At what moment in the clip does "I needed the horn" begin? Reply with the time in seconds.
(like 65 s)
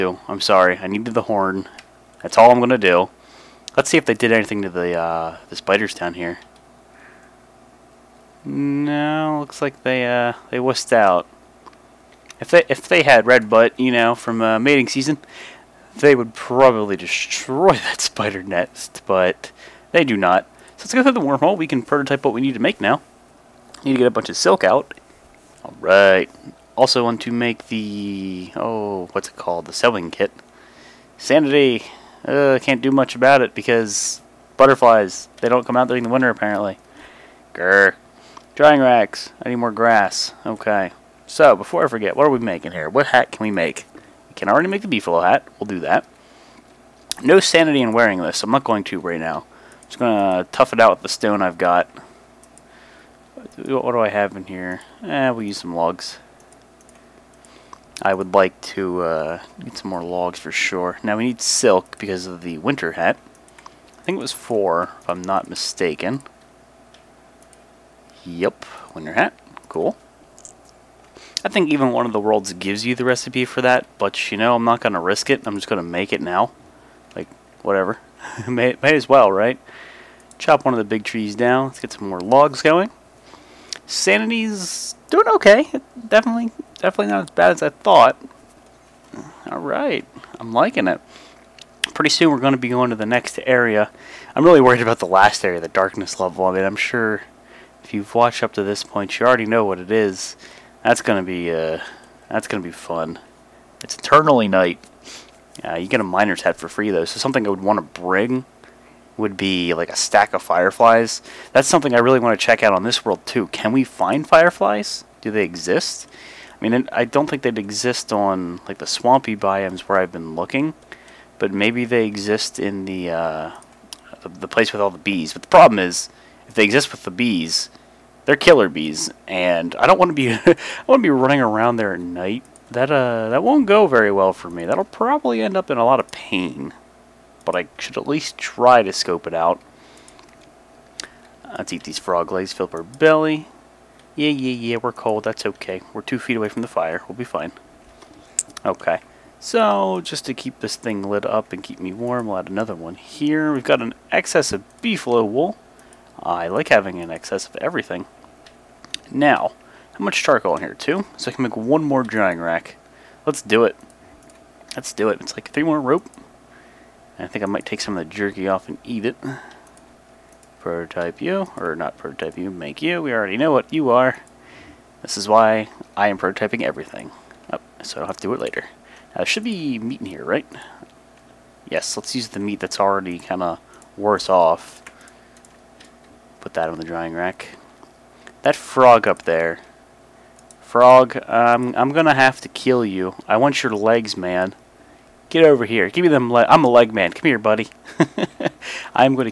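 0 s.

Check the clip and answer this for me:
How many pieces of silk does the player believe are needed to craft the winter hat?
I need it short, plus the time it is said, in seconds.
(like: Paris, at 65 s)
4, at 64 s.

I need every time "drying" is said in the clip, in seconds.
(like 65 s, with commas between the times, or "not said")
38 s, 162 s, 186 s.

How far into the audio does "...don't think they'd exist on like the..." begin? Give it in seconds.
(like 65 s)
117 s.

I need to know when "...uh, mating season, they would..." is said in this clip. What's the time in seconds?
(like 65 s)
14 s.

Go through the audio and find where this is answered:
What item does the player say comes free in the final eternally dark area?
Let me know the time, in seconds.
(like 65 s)
106 s.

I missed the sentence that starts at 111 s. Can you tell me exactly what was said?
That's something I really want to check out on this world too.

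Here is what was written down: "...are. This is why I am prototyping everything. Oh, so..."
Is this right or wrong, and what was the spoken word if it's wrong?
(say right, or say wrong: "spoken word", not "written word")
right.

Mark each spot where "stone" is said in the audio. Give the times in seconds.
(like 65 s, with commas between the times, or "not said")
51 s.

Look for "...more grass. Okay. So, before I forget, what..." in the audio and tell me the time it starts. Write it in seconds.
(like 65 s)
39 s.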